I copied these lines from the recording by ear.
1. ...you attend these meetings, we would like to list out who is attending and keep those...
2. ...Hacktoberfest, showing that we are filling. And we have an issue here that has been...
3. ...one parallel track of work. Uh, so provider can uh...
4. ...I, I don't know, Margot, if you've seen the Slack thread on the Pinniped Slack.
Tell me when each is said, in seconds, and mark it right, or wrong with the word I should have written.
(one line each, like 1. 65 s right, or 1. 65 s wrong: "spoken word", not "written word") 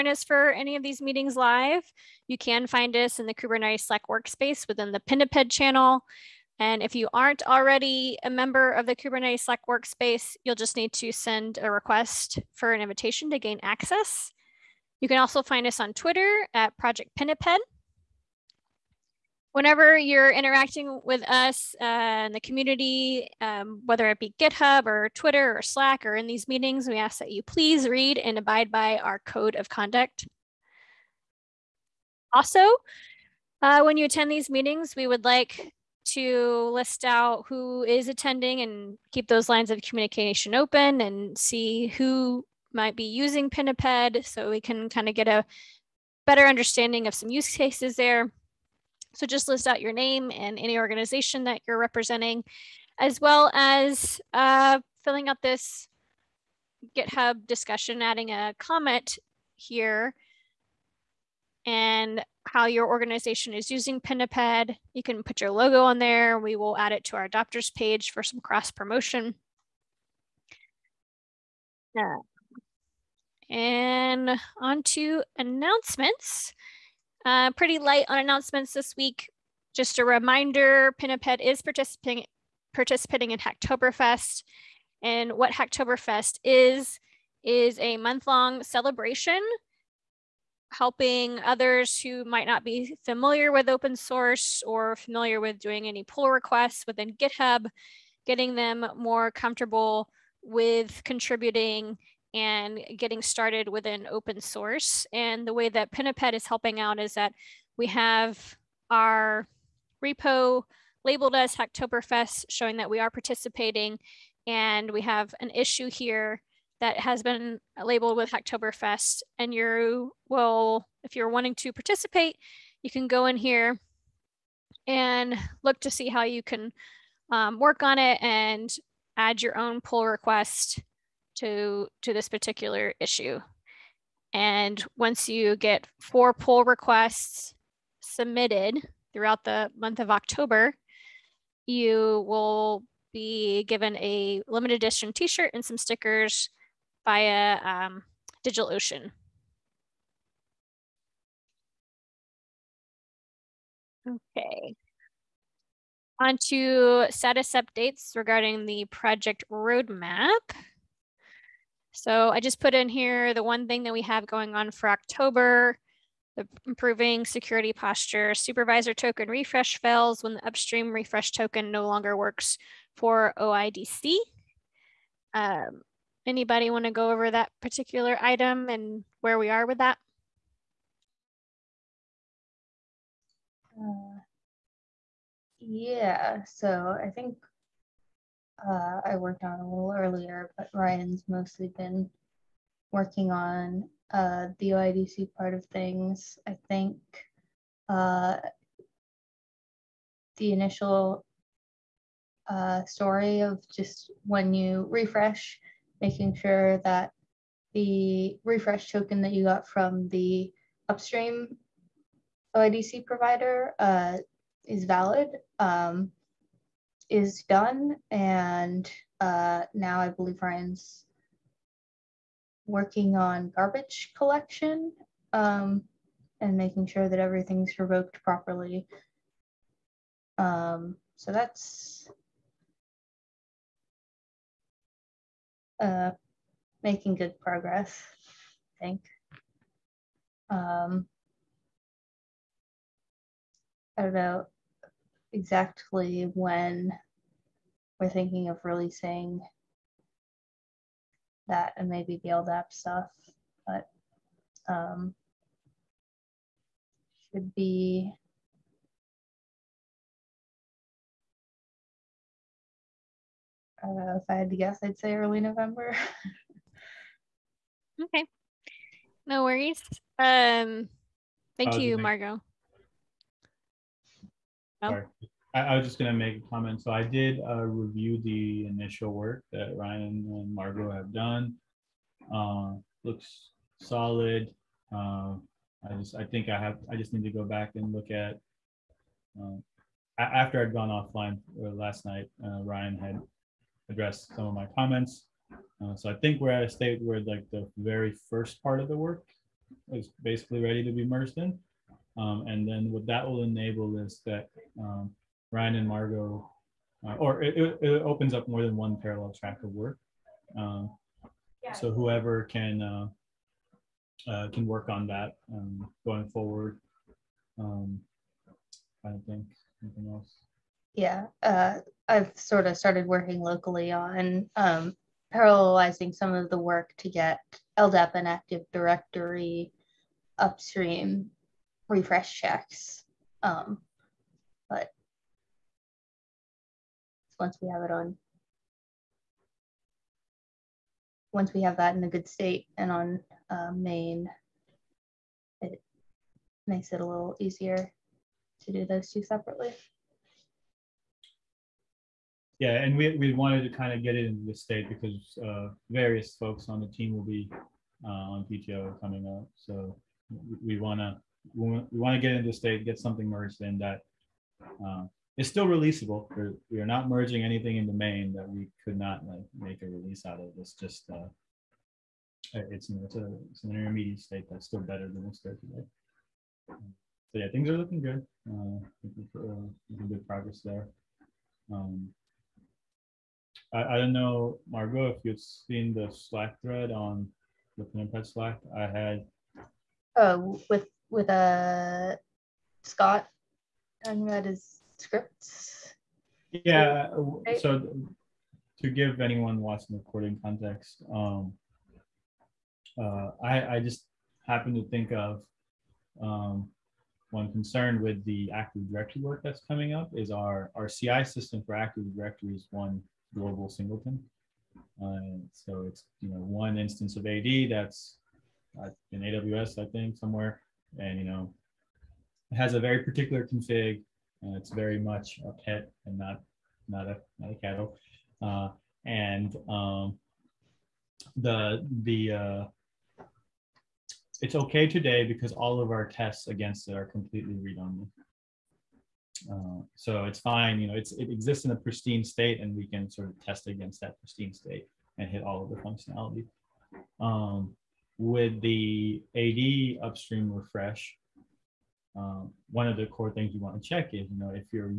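1. 33 s right
2. 111 s wrong: "participating", not "filling"
3. 308 s wrong: "whoever", not "provider"
4. 383 s right.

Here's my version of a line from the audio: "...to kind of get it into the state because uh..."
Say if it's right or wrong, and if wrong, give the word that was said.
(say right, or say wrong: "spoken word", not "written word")
right.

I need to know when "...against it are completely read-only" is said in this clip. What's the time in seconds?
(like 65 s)
436 s.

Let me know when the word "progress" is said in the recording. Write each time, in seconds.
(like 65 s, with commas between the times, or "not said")
237 s, 380 s.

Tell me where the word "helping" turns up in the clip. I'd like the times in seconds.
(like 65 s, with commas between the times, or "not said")
90 s, 106 s.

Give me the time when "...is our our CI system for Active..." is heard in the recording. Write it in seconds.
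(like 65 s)
410 s.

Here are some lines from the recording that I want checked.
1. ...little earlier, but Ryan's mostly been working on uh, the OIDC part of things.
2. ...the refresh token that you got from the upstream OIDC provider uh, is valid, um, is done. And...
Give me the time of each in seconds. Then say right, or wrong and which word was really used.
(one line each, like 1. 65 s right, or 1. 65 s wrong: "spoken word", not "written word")
1. 189 s right
2. 207 s right.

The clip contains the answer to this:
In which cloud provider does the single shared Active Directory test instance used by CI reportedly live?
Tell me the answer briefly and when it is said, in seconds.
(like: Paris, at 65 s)
AWS, at 419 s.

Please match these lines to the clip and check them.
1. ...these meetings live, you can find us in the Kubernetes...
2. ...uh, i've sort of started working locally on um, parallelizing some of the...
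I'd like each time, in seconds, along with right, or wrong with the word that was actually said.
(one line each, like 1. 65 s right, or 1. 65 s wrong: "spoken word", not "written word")
1. 0 s right
2. 321 s right.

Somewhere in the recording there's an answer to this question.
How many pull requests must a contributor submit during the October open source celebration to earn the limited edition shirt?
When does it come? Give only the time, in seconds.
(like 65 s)
135 s.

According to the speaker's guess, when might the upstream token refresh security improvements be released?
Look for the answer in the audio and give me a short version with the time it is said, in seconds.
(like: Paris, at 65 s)
early November, at 265 s.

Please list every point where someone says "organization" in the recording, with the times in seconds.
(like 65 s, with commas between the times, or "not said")
50 s, 62 s.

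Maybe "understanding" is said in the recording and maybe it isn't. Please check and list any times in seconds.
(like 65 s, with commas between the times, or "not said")
46 s.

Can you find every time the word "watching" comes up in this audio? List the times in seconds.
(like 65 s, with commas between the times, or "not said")
399 s.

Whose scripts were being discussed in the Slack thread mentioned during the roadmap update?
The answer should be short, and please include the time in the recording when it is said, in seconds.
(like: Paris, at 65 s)
Scott, at 392 s.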